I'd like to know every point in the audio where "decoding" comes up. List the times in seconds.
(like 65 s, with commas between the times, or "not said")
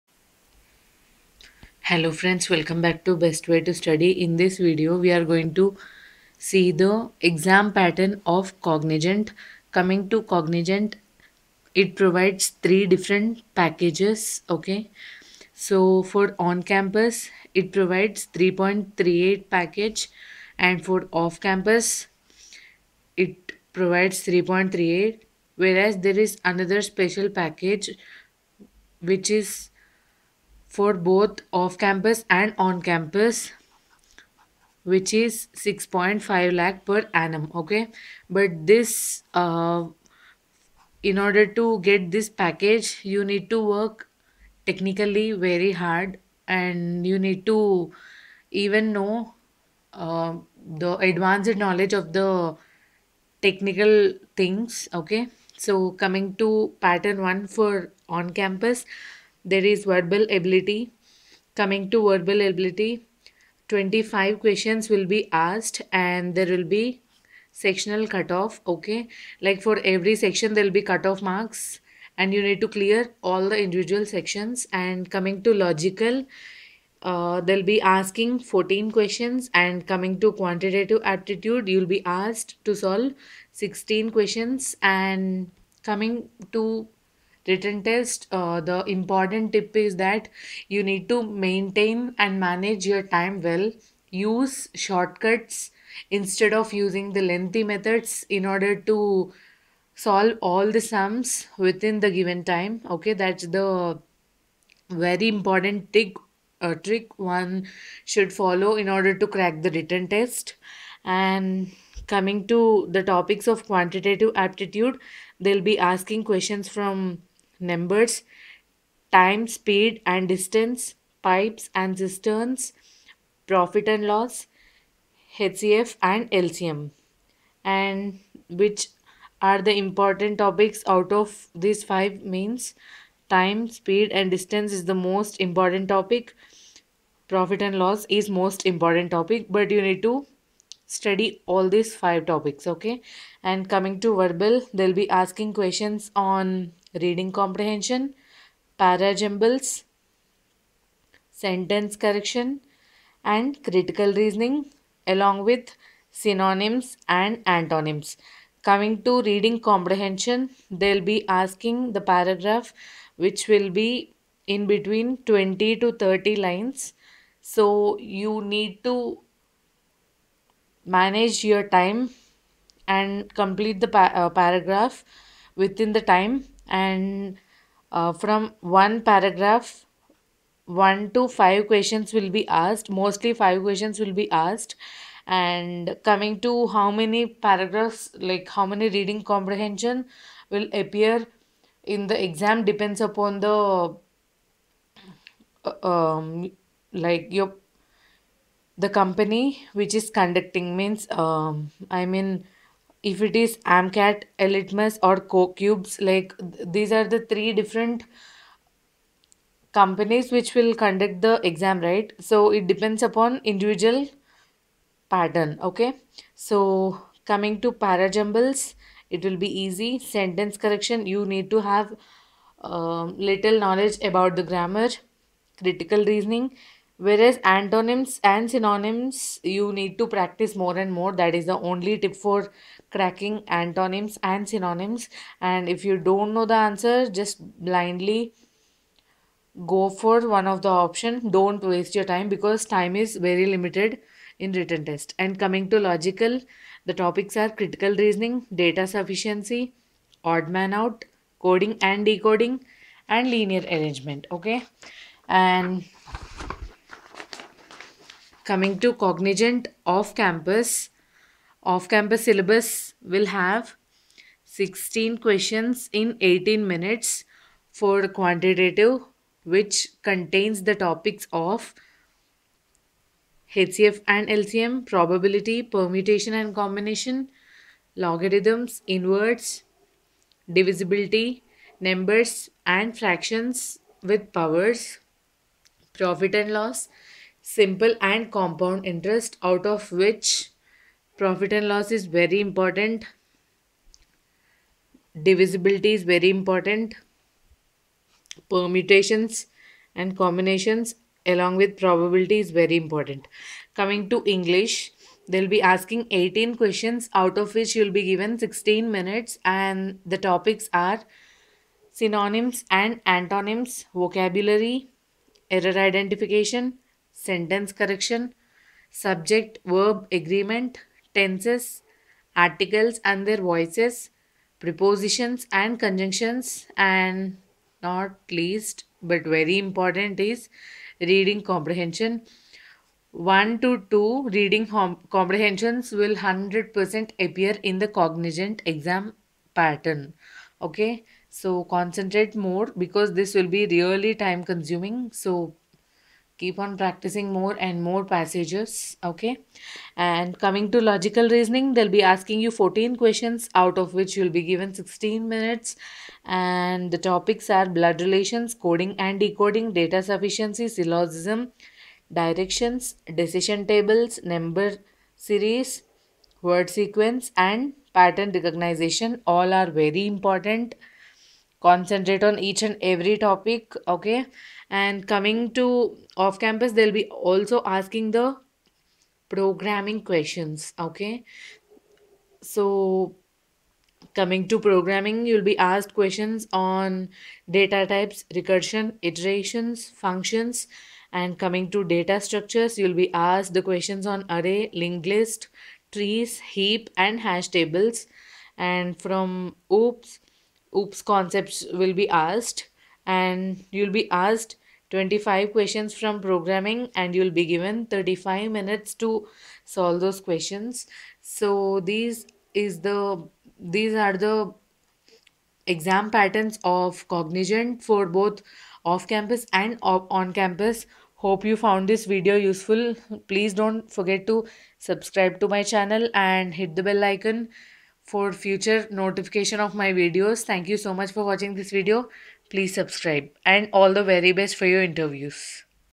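252 s, 359 s.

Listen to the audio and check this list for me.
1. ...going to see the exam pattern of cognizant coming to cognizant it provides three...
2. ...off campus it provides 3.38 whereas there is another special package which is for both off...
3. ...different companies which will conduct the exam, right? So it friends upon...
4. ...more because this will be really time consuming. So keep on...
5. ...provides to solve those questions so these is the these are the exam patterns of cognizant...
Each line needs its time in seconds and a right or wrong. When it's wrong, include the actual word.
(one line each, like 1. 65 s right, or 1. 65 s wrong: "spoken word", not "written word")
1. 5 s right
2. 21 s right
3. 207 s wrong: "depends", not "friends"
4. 342 s right
5. 408 s wrong: "minutes", not "provides".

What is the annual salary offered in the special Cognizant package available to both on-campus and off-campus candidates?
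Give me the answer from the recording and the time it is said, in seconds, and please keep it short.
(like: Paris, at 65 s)
6.5 lakh per annum, at 35 s.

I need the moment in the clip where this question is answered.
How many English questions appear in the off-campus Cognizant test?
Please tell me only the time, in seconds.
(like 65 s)
306 s.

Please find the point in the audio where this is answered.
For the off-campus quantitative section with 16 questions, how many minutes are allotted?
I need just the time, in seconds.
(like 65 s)
266 s.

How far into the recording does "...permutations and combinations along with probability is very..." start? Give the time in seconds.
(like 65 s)
298 s.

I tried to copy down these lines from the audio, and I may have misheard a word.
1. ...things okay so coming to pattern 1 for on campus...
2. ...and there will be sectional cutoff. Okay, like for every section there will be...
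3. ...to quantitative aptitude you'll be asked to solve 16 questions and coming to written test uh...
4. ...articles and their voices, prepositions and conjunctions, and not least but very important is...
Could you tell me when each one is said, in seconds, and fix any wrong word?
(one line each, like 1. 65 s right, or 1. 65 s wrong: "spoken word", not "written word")
1. 54 s right
2. 65 s right
3. 80 s right
4. 322 s right.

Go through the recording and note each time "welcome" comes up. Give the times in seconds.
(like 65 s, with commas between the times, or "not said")
2 s.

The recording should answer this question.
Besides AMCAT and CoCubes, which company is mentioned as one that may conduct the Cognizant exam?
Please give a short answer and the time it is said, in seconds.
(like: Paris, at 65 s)
eLitmus, at 204 s.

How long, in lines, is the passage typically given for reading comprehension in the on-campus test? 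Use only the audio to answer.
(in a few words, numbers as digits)
20 to 30 lines.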